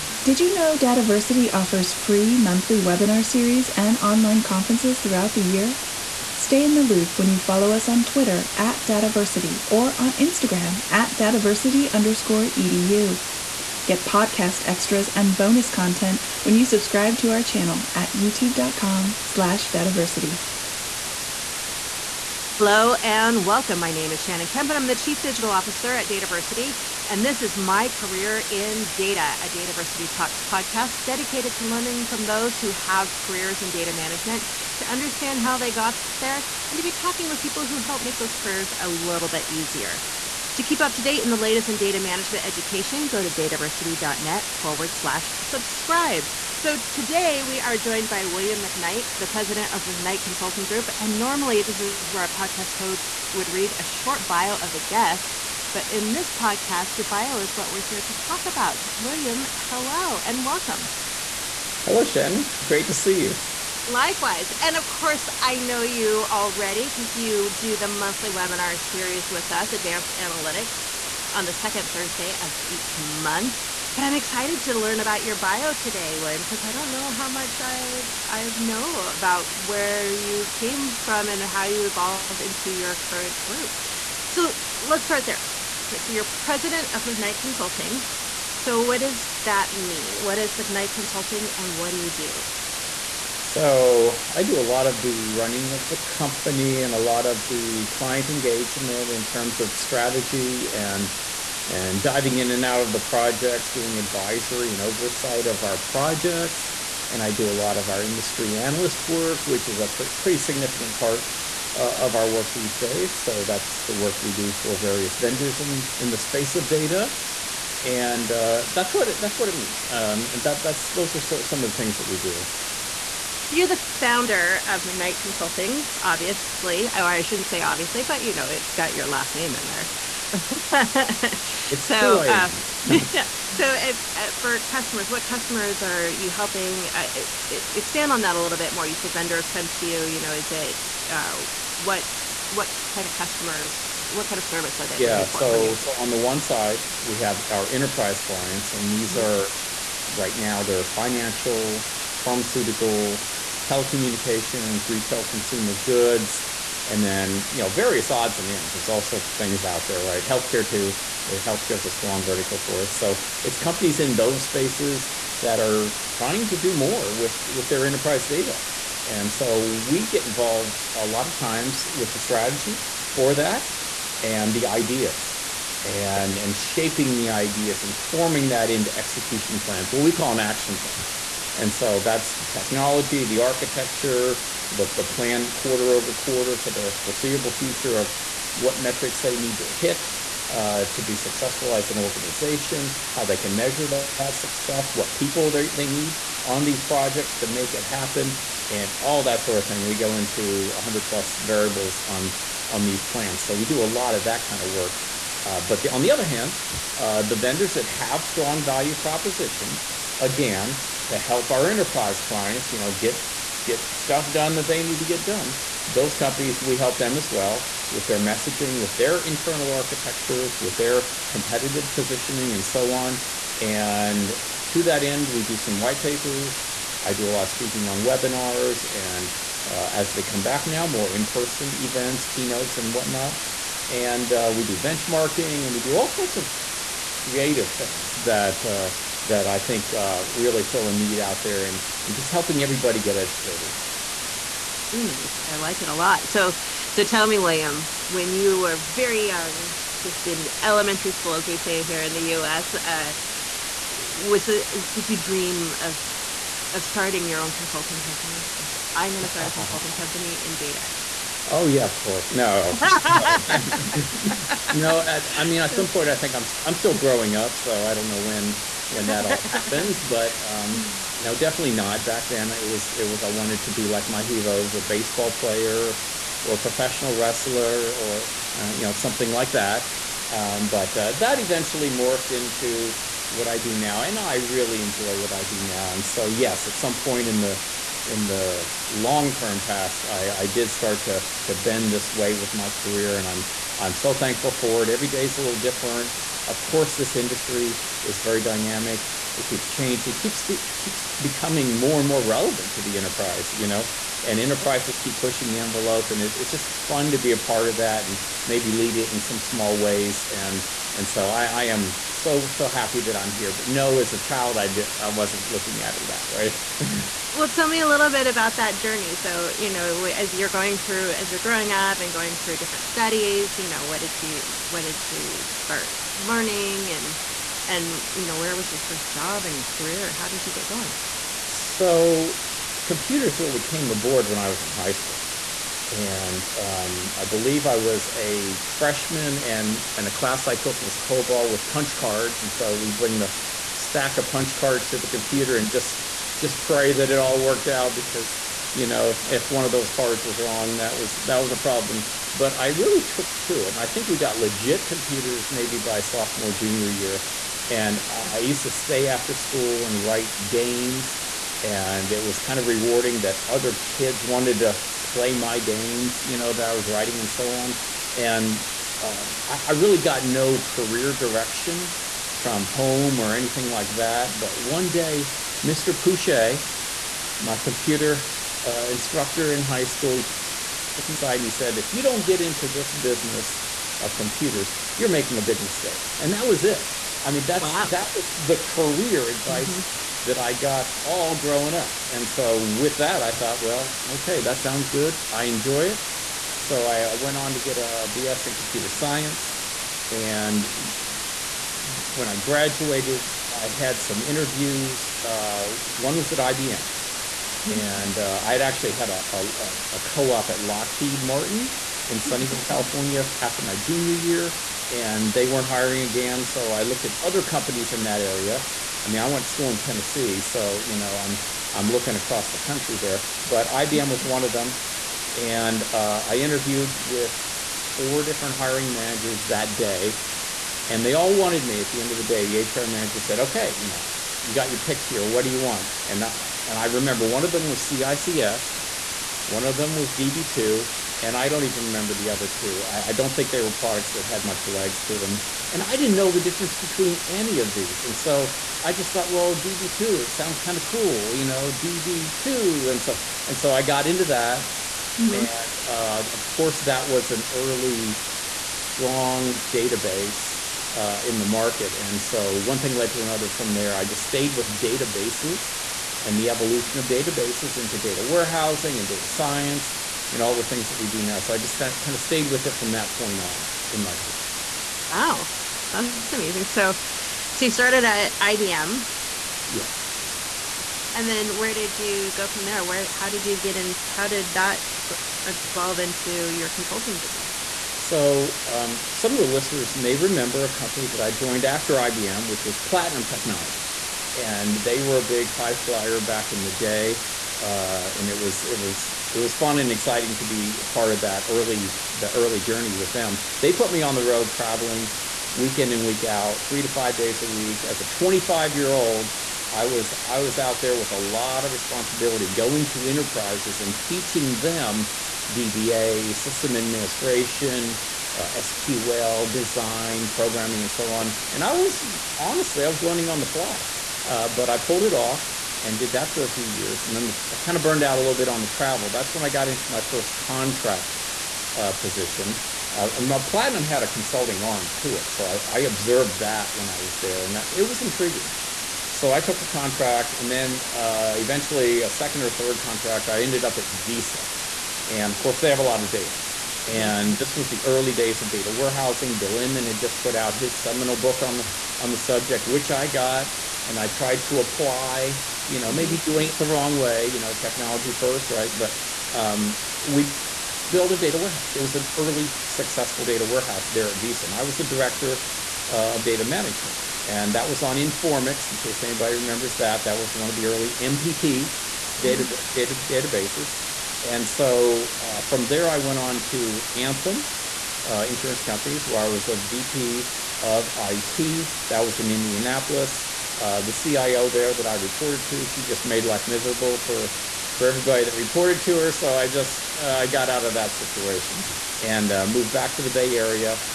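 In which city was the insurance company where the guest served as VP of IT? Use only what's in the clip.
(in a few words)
Indianapolis.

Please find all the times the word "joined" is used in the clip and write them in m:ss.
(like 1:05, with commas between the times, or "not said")
0:47, 8:11.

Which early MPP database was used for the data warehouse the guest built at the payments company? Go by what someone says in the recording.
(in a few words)
Informix.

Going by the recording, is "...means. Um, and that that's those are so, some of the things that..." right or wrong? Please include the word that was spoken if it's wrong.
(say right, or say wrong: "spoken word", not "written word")
right.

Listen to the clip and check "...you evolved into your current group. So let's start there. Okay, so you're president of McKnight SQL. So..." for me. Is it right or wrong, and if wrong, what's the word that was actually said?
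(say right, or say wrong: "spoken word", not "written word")
wrong: "Consulting", not "SQL".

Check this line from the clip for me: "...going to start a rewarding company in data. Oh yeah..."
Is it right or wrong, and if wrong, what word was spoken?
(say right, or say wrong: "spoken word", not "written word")
wrong: "consulting", not "rewarding".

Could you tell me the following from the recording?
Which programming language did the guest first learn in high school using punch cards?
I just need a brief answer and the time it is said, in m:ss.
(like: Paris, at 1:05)
COBOL, at 5:40.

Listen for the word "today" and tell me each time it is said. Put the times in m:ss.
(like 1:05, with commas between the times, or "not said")
0:46, 1:15.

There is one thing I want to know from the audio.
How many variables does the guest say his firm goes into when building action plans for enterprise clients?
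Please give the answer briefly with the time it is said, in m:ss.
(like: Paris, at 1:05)
100 plus, at 3:20.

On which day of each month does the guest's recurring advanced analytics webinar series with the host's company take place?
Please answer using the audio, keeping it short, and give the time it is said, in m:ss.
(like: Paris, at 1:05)
Second Thursday, at 1:11.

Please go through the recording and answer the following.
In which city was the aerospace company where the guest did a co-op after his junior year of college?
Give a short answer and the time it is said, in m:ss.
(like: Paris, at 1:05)
Sunnyvale, at 6:52.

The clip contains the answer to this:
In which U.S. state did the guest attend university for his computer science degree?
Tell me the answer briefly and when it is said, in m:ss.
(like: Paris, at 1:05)
Tennessee, at 6:59.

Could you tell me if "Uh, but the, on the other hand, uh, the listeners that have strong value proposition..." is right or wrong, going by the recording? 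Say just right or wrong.
wrong.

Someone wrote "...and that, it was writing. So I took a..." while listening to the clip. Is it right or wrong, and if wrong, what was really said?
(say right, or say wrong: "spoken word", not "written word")
wrong: "intriguing", not "writing".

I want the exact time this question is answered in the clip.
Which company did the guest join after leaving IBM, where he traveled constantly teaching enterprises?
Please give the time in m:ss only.
8:12.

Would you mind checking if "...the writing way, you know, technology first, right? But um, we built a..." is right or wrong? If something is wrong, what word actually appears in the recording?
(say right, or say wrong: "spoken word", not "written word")
wrong: "wrong", not "writing".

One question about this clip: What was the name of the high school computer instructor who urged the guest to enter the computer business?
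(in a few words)
Mr. Pouchet.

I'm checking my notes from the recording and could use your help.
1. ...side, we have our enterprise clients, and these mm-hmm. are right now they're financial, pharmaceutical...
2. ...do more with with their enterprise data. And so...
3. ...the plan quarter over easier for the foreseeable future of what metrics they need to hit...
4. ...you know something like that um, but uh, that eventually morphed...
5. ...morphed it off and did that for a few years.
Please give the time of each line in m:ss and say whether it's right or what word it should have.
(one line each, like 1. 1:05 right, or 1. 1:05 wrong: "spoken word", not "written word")
1. 2:26 right
2. 2:46 right
3. 3:04 wrong: "quarter", not "easier"
4. 4:38 right
5. 8:44 wrong: "pulled", not "morphed".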